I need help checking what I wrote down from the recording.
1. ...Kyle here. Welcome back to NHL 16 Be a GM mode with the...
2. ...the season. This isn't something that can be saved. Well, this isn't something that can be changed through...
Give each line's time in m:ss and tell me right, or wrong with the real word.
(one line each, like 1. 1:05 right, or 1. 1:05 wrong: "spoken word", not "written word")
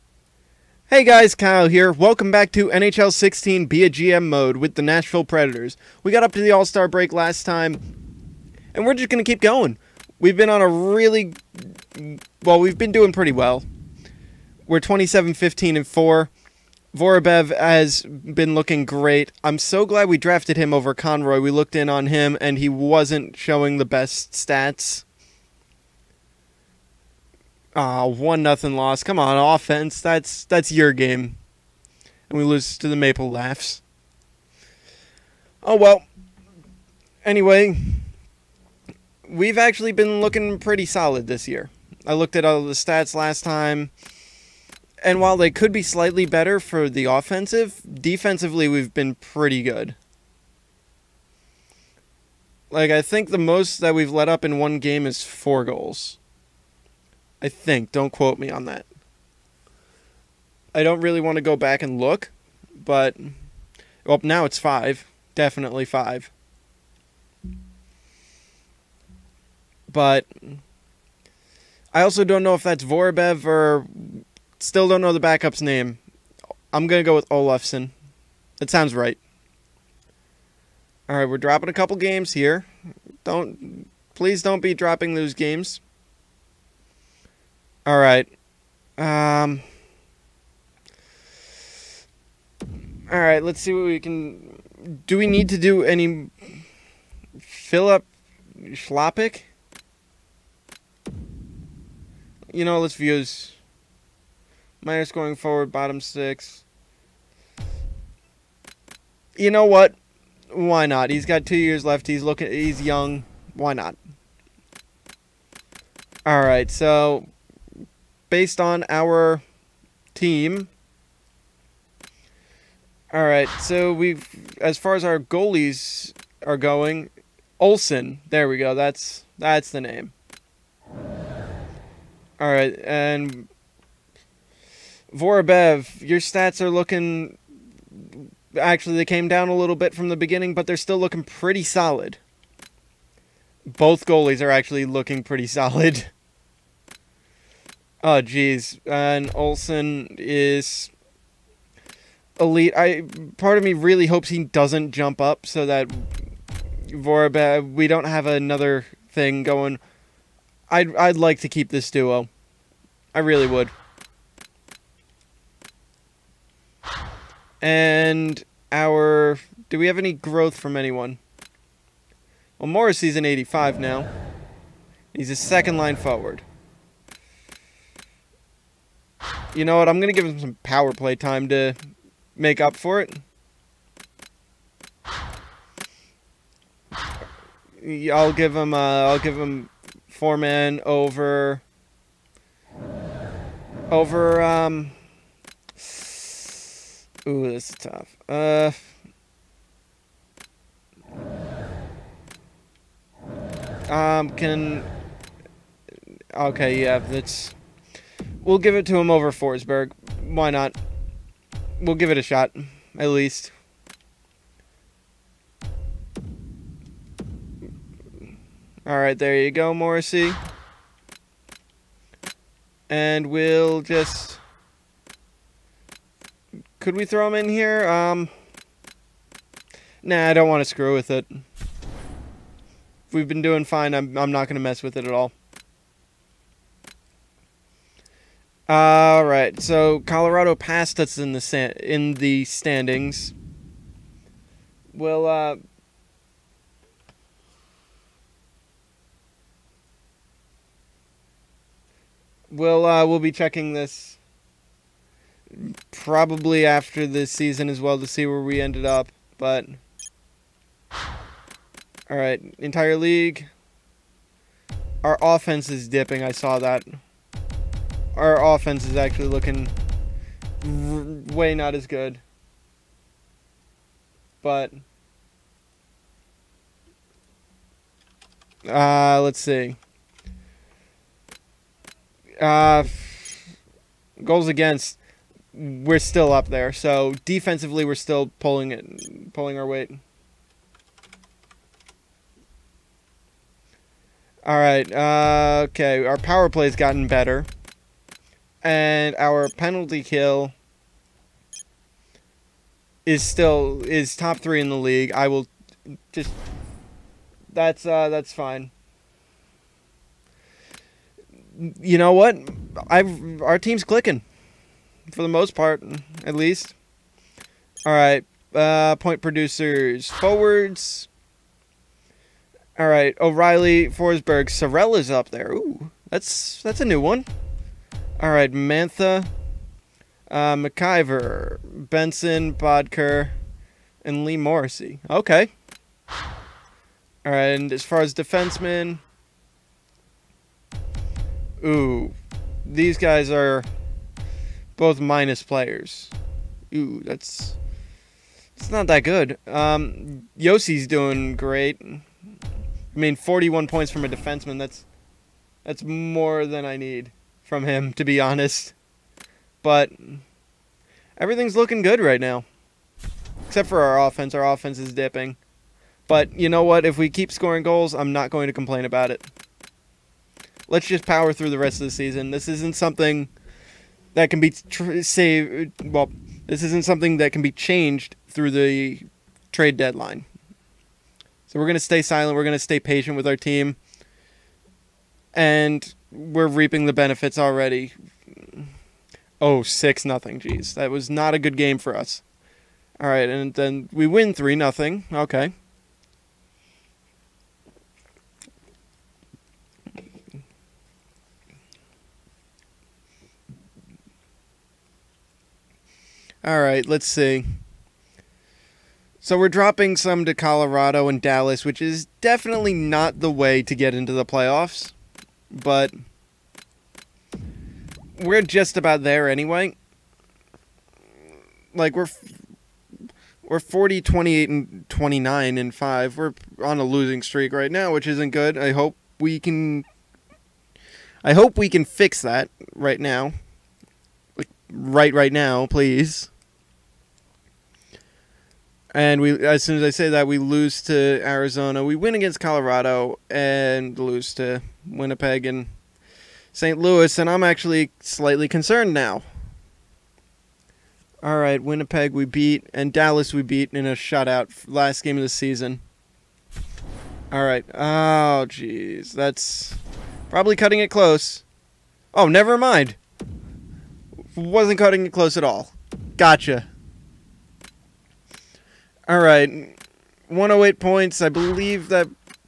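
1. 0:01 right
2. 6:11 right.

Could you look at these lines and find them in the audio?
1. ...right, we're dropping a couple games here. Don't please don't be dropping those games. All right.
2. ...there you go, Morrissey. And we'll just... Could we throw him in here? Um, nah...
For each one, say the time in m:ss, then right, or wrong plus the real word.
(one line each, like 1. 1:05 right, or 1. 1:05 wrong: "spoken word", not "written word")
1. 1:21 right
2. 3:39 right.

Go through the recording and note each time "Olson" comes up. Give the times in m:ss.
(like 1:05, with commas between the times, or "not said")
2:07, 2:29.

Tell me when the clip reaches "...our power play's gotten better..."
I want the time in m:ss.
4:56.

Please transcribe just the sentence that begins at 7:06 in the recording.
We're on a losing streak right now, which isn't good.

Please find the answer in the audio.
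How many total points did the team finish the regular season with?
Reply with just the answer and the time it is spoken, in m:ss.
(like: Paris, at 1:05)
108, at 7:50.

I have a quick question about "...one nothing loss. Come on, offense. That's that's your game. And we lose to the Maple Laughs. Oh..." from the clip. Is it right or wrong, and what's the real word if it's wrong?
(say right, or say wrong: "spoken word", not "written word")
right.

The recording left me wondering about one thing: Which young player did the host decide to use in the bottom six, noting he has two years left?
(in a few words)
Philip Schlopik.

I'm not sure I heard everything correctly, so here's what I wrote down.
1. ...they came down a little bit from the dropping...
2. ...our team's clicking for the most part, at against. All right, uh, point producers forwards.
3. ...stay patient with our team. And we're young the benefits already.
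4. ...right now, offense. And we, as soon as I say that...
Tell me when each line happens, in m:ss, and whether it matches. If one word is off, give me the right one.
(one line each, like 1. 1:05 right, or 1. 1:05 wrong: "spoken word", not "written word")
1. 2:18 wrong: "beginning", not "dropping"
2. 5:13 wrong: "least", not "against"
3. 6:22 wrong: "reaping", not "young"
4. 7:15 wrong: "please", not "offense".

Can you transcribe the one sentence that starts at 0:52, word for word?
Like I think the most that we've let up in one game is 4 goals.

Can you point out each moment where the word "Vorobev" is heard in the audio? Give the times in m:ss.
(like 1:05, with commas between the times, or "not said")
0:16, 1:12, 2:15.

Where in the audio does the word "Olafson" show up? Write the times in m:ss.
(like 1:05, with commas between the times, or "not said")
1:17.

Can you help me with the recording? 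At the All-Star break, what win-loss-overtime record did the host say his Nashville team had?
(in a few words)
27-15-4.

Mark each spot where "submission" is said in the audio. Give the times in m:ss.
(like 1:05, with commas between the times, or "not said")
not said.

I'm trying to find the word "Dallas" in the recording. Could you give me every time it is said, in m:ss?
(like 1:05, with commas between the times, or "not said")
6:51, 7:32.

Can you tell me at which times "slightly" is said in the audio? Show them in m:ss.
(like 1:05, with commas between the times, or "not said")
0:45, 7:27.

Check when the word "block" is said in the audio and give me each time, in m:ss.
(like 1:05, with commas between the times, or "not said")
not said.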